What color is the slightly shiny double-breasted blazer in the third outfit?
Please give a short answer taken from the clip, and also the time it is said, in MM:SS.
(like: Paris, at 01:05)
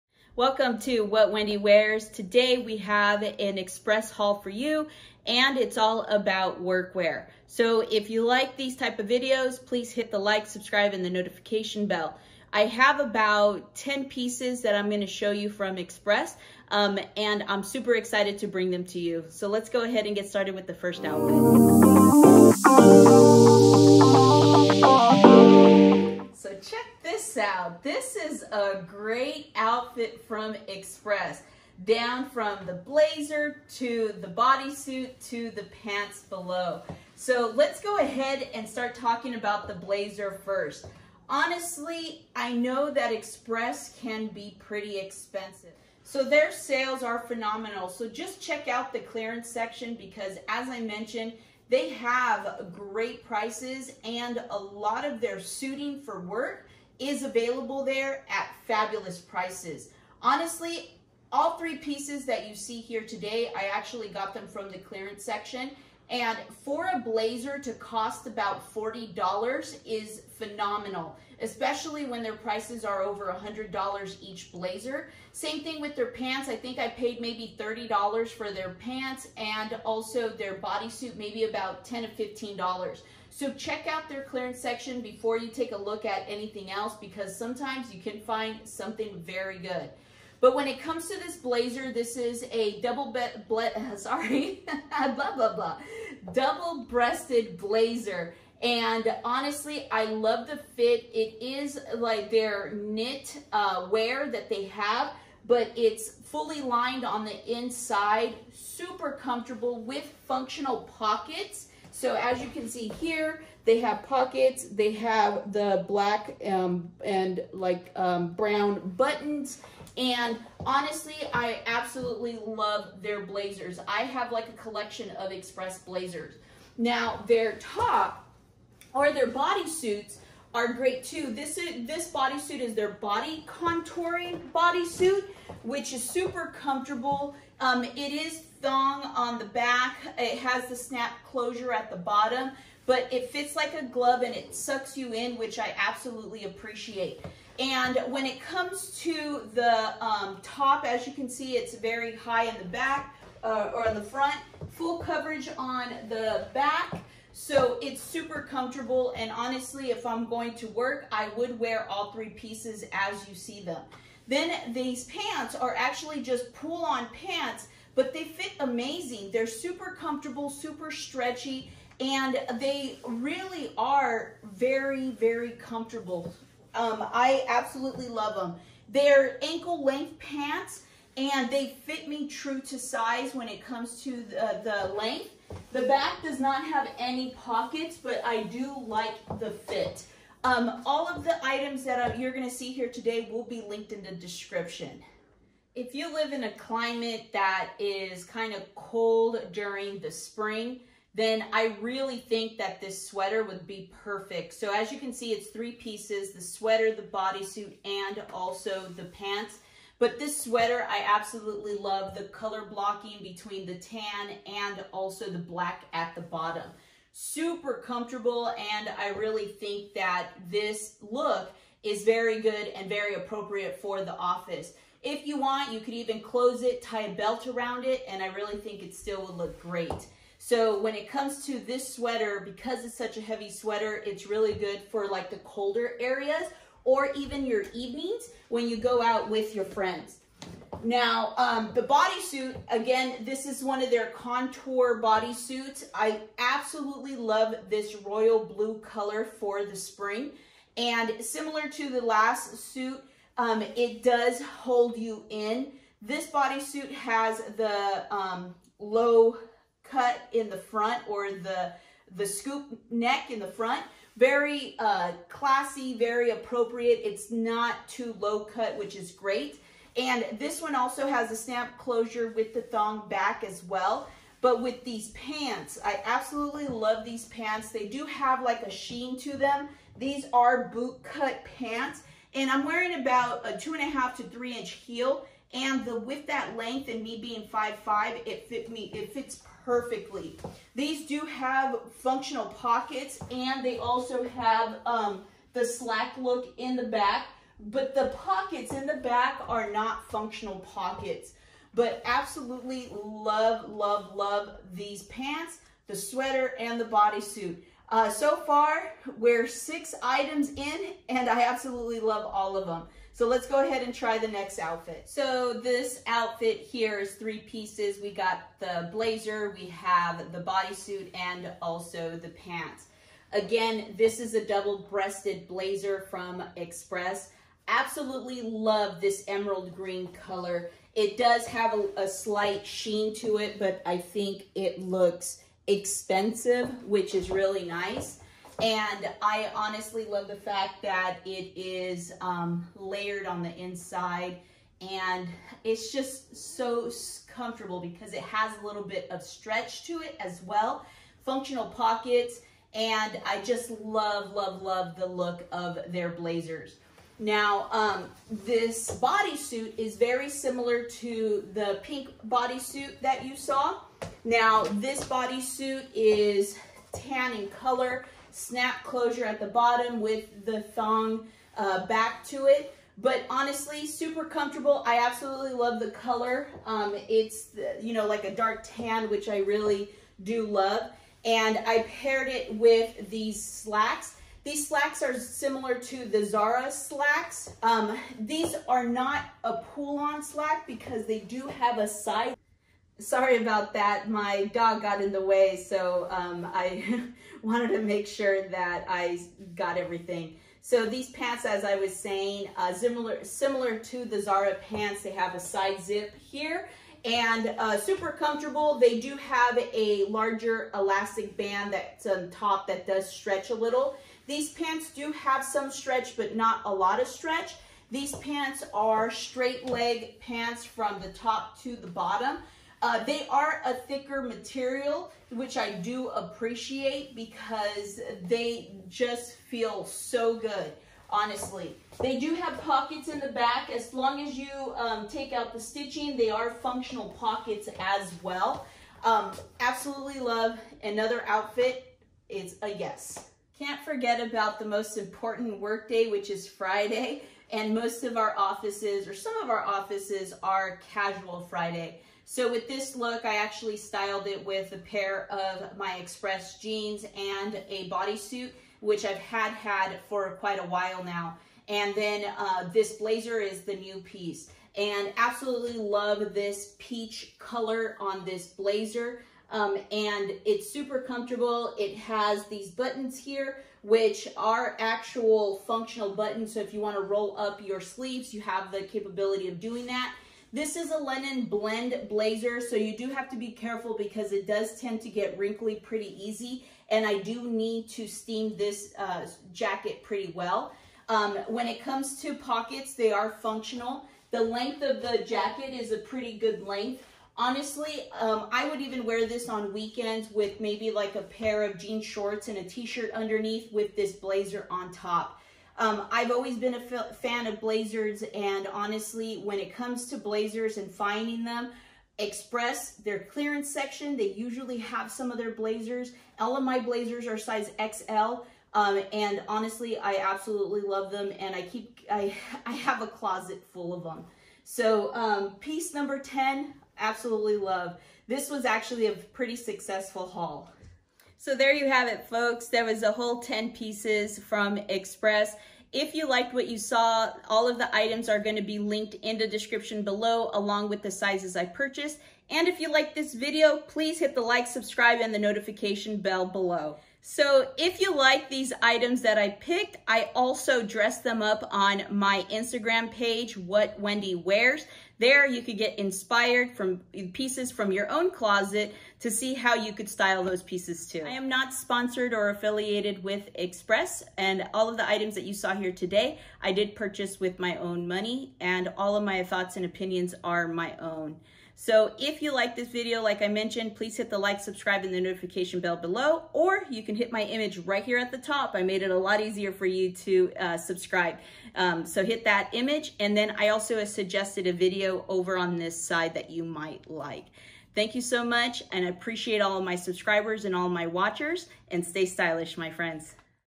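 emerald green, at 05:29.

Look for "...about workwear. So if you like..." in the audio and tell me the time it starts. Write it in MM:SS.
00:06.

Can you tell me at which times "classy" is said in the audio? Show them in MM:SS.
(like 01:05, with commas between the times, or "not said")
04:25.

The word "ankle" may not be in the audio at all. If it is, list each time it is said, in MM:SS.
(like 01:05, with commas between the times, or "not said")
02:59.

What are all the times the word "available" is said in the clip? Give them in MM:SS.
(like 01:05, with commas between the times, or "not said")
00:57.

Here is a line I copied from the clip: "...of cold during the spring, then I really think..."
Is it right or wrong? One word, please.
right.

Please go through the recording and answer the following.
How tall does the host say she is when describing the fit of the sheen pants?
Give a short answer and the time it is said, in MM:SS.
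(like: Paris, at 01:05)
5'5", at 04:47.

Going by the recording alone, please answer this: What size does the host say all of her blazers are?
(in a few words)
XL.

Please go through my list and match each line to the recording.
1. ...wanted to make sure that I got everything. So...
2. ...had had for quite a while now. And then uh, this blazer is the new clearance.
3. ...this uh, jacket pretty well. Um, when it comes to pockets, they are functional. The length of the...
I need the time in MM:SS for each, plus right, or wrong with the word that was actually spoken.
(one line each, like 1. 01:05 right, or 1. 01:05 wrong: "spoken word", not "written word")
1. 06:37 right
2. 07:39 wrong: "piece", not "clearance"
3. 08:08 right.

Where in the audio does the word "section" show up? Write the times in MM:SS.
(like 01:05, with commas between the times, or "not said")
00:49, 01:05, 01:24, 08:33.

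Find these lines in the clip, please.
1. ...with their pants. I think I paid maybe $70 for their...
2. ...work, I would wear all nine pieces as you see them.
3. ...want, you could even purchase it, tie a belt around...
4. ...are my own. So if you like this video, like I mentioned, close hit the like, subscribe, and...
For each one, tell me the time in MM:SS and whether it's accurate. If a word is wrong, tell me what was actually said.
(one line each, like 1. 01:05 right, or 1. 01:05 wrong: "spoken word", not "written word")
1. 01:15 wrong: "30", not "70"
2. 02:40 wrong: "three", not "nine"
3. 03:45 wrong: "close", not "purchase"
4. 09:30 wrong: "please", not "close".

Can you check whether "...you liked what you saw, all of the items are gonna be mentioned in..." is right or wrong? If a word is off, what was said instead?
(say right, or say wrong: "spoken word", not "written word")
wrong: "linked", not "mentioned".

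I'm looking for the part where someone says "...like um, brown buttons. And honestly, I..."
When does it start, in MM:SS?
01:57.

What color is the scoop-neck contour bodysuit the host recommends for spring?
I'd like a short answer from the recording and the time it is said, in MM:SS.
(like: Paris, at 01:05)
royal blue, at 04:07.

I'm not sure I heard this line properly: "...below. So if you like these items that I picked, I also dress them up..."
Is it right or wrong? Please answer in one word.
right.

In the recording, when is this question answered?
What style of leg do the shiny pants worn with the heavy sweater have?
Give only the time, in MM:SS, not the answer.
04:40.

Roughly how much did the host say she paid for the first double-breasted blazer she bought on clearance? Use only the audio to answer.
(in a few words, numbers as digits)
$40.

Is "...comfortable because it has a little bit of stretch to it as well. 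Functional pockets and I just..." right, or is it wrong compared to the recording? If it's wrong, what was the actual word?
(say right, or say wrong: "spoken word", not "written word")
right.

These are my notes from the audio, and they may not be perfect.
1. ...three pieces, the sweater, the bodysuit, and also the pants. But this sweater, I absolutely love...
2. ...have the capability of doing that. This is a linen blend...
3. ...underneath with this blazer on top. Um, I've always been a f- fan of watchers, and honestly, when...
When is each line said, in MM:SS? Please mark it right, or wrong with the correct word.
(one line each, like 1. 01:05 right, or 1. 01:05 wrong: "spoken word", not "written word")
1. 03:25 right
2. 07:58 right
3. 08:23 wrong: "blazers", not "watchers".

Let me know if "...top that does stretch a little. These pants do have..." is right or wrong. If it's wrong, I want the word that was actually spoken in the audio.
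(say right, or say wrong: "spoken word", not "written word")
right.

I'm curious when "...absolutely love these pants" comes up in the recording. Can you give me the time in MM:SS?
04:36.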